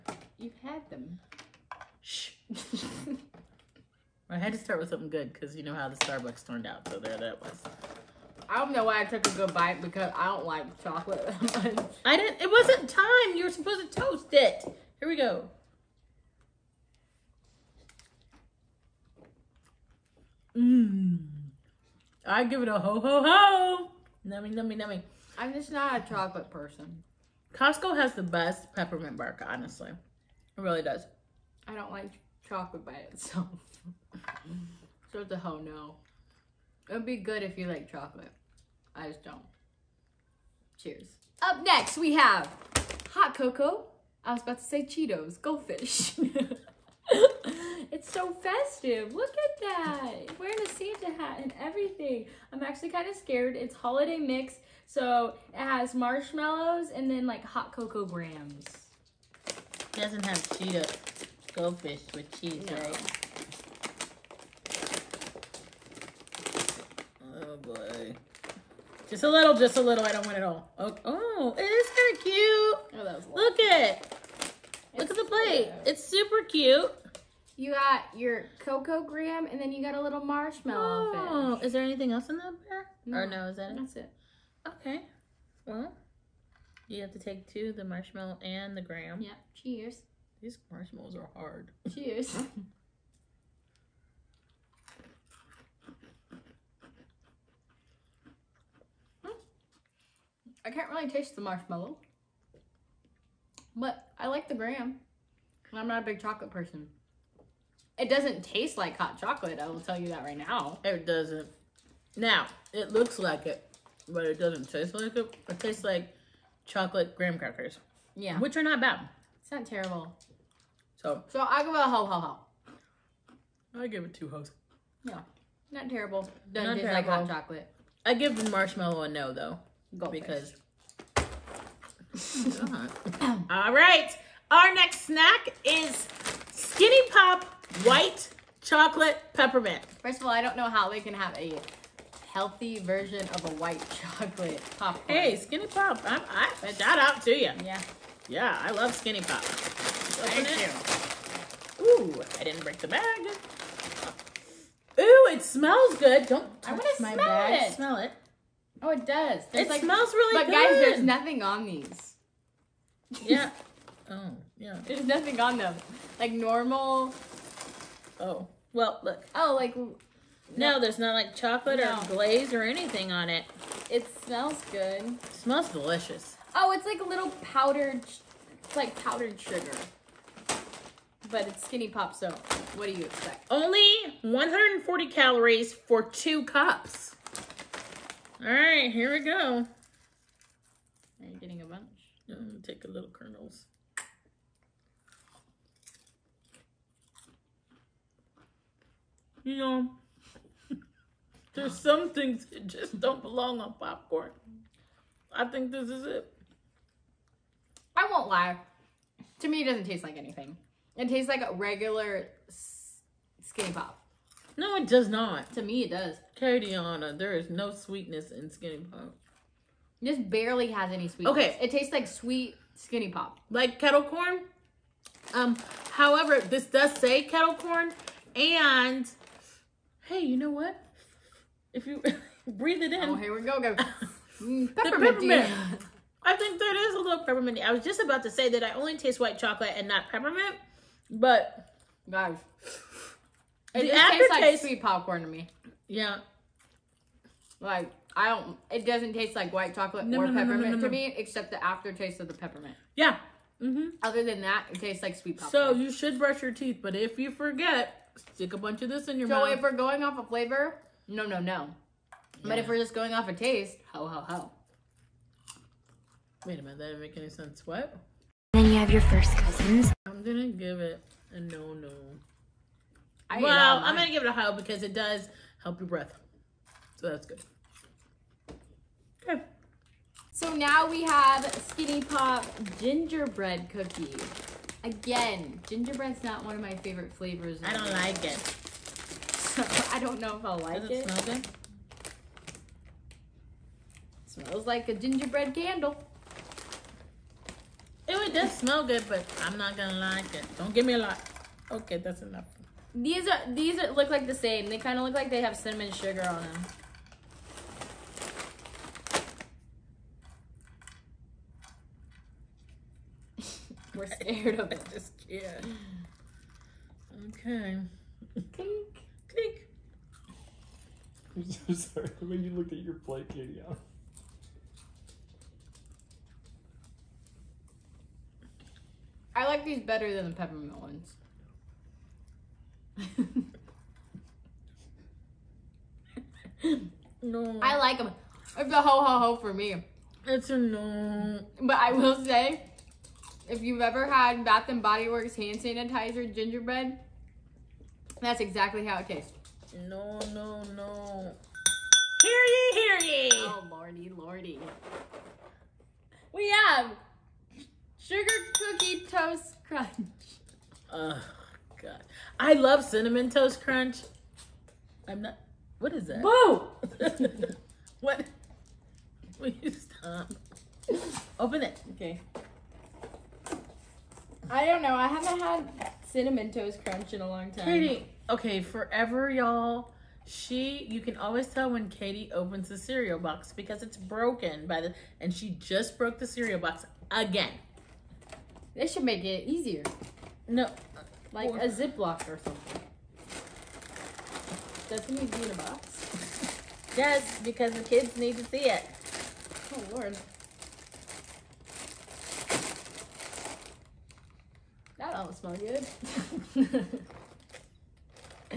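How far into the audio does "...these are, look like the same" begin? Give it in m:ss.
5:03.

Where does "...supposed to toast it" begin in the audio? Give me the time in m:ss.
0:13.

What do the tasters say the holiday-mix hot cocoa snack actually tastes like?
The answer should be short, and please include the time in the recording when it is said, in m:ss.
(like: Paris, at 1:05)
Chocolate graham crackers, at 1:56.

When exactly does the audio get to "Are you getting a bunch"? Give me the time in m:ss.
3:11.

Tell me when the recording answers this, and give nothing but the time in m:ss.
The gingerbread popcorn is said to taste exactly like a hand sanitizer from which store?
5:44.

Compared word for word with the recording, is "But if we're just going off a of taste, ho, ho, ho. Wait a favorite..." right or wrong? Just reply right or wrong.
wrong.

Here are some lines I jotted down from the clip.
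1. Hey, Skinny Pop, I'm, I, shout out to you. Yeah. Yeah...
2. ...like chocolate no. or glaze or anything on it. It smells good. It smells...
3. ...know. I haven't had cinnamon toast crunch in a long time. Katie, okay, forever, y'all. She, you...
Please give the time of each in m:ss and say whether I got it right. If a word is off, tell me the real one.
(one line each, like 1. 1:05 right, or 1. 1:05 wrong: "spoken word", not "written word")
1. 2:25 right
2. 2:51 right
3. 6:14 right.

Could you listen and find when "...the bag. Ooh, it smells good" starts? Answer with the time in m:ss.
2:32.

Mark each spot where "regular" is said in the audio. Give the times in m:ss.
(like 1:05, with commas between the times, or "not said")
3:31.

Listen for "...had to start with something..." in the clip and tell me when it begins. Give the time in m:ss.
0:04.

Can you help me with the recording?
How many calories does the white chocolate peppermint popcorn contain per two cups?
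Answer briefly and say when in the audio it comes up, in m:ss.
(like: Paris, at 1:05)
140, at 3:04.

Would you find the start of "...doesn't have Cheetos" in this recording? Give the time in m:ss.
0:59.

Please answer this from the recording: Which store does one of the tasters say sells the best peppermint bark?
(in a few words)
Costco.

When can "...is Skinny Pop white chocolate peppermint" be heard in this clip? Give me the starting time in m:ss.
2:15.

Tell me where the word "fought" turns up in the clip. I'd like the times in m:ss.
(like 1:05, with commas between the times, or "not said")
not said.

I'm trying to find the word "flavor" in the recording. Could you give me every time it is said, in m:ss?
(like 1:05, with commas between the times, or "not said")
4:20, 4:47.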